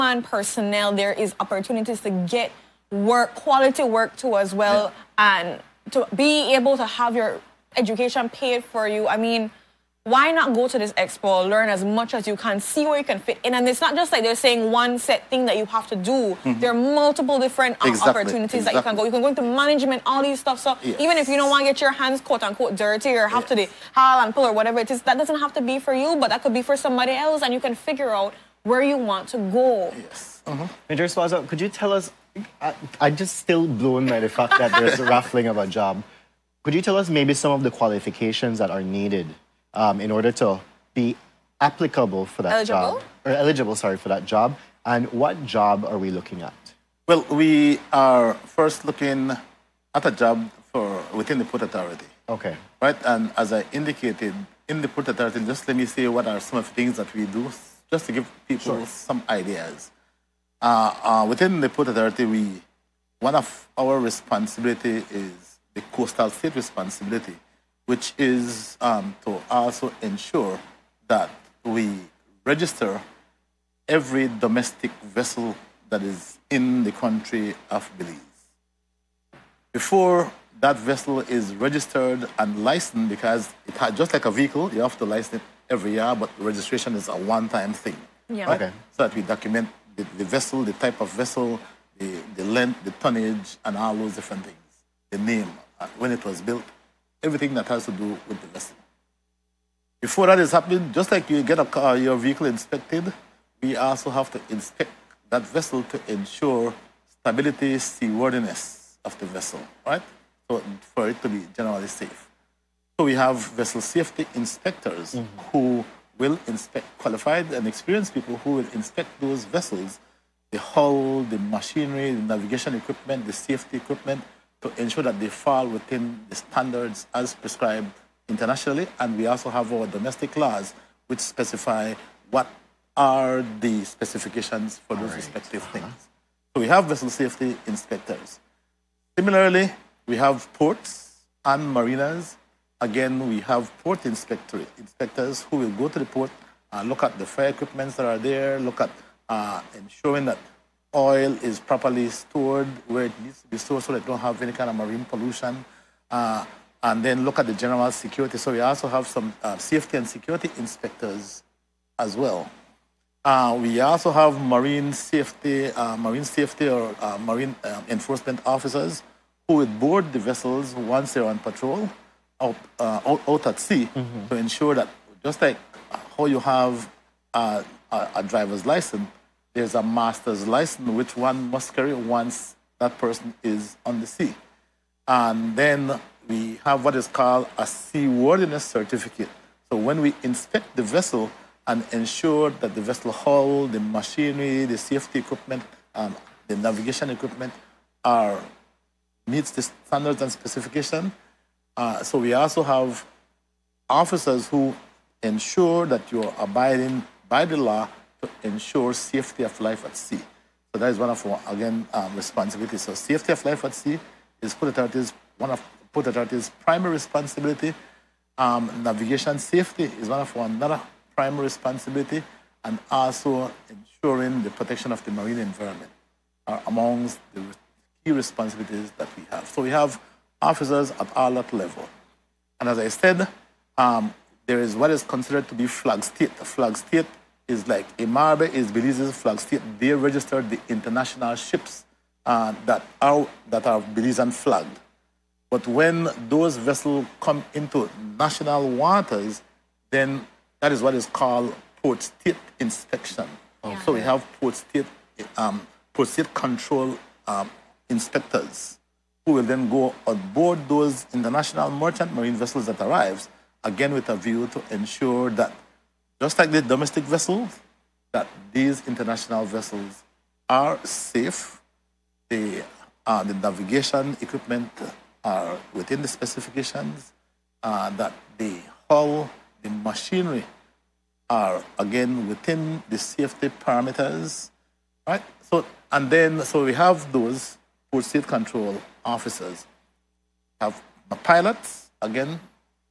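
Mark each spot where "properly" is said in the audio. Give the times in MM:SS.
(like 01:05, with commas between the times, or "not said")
02:31.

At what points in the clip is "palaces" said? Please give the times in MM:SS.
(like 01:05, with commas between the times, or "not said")
not said.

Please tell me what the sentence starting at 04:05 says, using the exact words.
But when those vessels come into national waters, then that is what is called port state inspection.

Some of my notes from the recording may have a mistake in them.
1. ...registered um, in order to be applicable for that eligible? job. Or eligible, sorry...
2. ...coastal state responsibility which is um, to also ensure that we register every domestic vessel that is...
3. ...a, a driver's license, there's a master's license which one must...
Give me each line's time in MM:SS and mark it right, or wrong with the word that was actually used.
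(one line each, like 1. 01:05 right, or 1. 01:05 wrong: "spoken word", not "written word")
1. 00:38 wrong: "needed", not "registered"
2. 01:05 right
3. 02:57 right.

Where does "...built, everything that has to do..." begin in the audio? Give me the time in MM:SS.
01:36.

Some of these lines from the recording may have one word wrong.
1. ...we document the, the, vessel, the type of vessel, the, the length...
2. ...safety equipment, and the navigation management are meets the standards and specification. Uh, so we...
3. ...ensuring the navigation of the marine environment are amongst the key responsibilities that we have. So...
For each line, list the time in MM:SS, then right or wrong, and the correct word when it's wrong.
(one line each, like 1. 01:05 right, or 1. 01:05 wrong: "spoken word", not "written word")
1. 01:29 right
2. 03:14 wrong: "equipment", not "management"
3. 03:43 wrong: "protection", not "navigation".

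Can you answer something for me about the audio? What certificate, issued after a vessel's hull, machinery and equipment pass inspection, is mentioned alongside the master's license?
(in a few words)
Seaworthiness certificate.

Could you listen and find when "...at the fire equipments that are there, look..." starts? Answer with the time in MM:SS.
02:27.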